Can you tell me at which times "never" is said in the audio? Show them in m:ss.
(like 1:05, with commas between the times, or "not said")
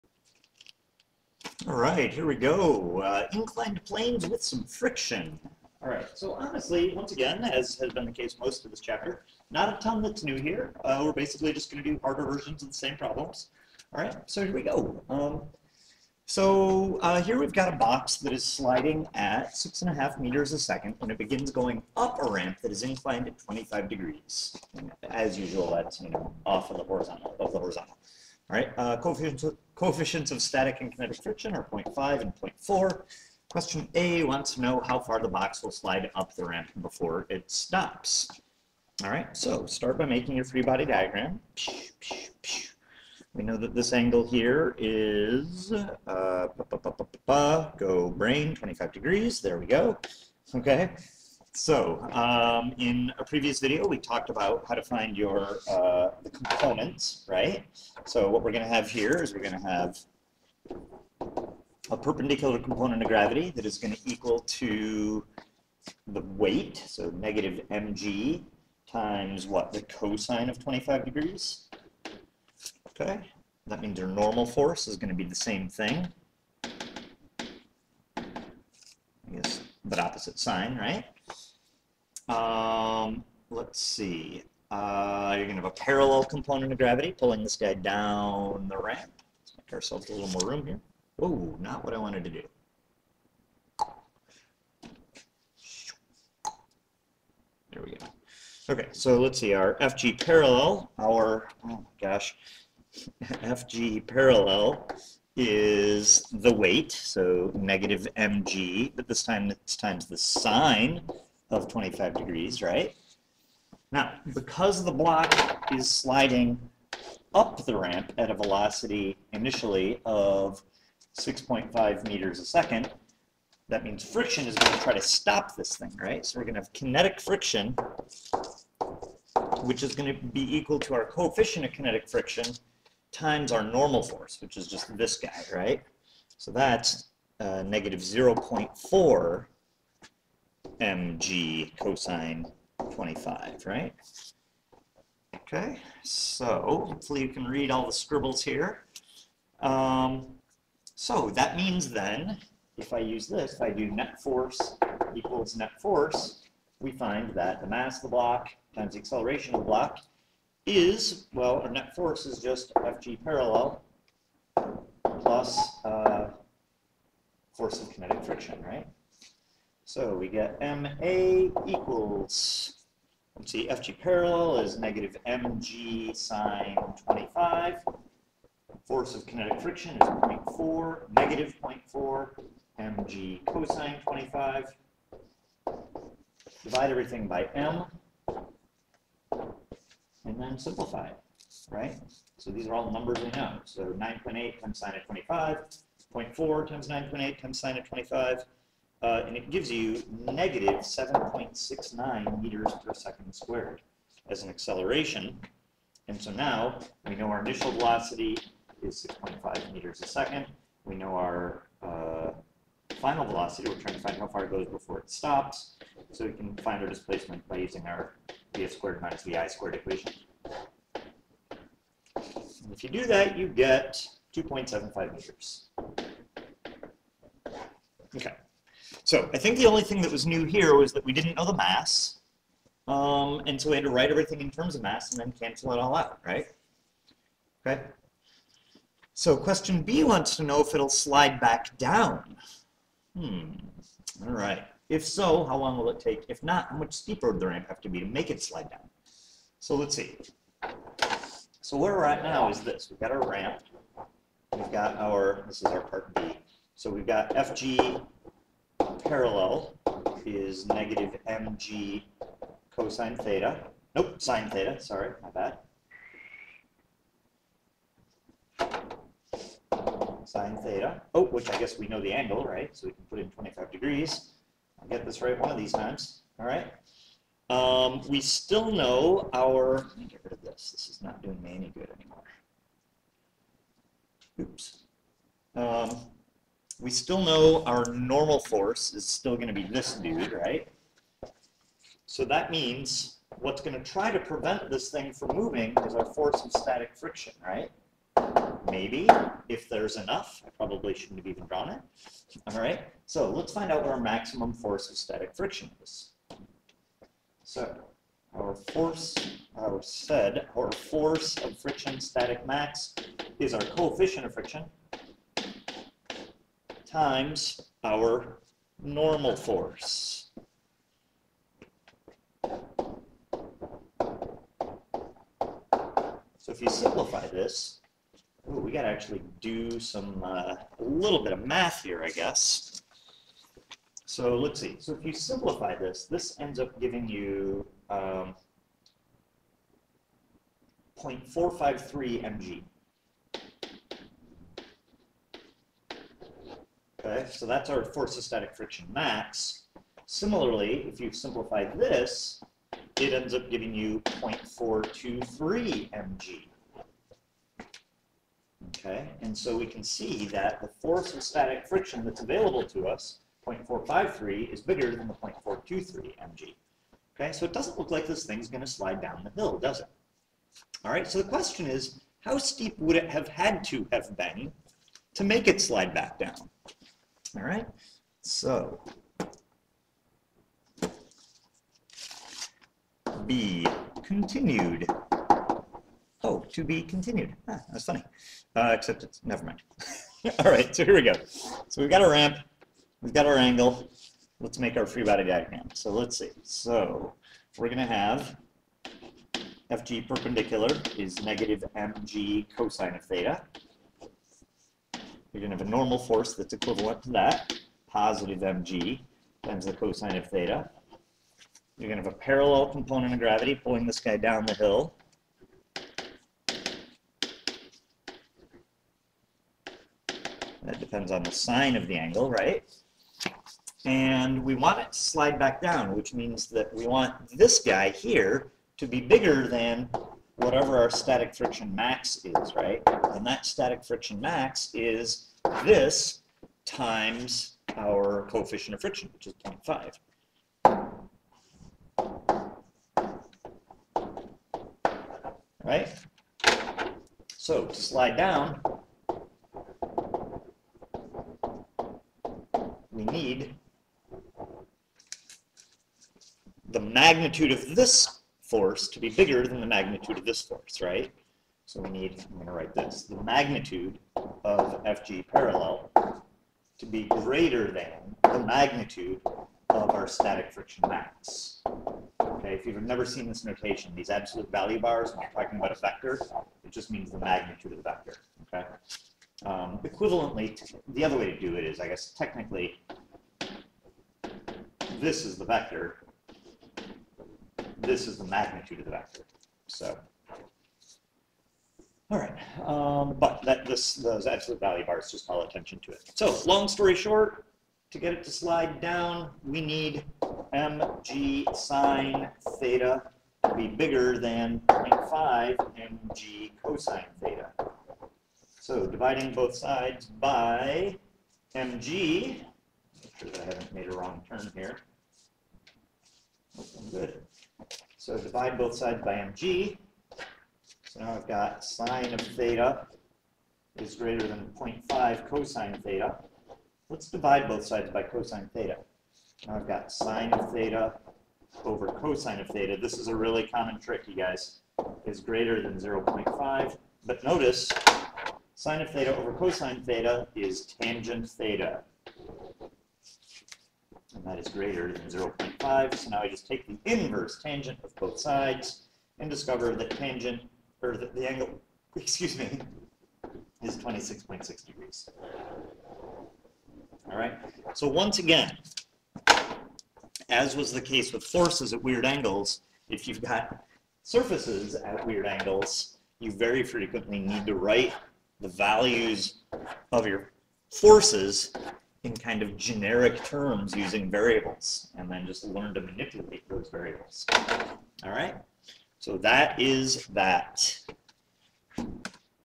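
6:29, 7:52.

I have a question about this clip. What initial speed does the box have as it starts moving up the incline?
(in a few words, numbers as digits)
6.5 meters per second.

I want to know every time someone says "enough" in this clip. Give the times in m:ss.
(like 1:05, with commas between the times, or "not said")
4:59.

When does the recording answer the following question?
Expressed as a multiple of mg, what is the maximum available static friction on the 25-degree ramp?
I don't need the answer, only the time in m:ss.
5:40.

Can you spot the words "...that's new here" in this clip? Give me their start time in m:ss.
0:10.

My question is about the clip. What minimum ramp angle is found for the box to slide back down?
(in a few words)
26.6 degrees.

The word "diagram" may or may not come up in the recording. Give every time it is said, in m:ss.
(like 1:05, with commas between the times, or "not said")
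0:40, 6:35.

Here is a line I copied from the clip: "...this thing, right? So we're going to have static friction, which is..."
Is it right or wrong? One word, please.
wrong.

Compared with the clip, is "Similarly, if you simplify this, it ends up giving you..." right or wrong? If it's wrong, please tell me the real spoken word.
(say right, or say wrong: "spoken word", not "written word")
right.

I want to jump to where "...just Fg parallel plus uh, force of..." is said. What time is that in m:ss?
2:42.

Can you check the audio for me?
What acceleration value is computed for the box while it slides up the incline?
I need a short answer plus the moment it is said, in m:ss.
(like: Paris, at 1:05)
-7.69 m/s^2, at 3:20.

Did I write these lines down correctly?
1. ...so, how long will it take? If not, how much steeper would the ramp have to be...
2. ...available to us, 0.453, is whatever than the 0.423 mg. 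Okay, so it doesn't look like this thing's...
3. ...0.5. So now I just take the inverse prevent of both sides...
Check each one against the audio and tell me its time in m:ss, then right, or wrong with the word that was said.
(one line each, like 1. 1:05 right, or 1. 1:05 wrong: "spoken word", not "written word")
1. 4:05 right
2. 6:02 wrong: "bigger", not "whatever"
3. 9:05 wrong: "tangent", not "prevent".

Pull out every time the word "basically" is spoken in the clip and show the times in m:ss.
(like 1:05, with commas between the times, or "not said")
0:11.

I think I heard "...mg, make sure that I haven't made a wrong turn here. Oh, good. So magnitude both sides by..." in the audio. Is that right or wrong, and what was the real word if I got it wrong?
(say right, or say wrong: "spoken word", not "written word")
wrong: "divide", not "magnitude".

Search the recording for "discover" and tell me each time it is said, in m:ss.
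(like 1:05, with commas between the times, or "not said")
9:09.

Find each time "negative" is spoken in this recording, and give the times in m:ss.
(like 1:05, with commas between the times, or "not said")
1:07, 1:47, 2:17, 2:54, 3:01, 3:20, 4:20, 6:41.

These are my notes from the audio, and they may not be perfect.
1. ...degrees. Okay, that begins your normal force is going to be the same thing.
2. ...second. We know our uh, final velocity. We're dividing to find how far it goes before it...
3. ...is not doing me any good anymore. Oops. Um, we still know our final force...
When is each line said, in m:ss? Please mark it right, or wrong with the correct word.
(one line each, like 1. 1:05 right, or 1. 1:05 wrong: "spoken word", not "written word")
1. 1:11 wrong: "means", not "begins"
2. 3:30 wrong: "trying", not "dividing"
3. 4:40 wrong: "normal", not "final".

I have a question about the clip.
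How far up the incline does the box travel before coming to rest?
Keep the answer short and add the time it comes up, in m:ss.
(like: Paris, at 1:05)
2.75 meters, at 3:44.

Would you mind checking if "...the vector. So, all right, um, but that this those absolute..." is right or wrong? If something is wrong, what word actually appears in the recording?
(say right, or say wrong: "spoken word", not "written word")
right.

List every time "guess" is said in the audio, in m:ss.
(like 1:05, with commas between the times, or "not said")
1:19, 4:31, 5:32, 8:01.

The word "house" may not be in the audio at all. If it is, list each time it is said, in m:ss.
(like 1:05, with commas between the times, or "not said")
not said.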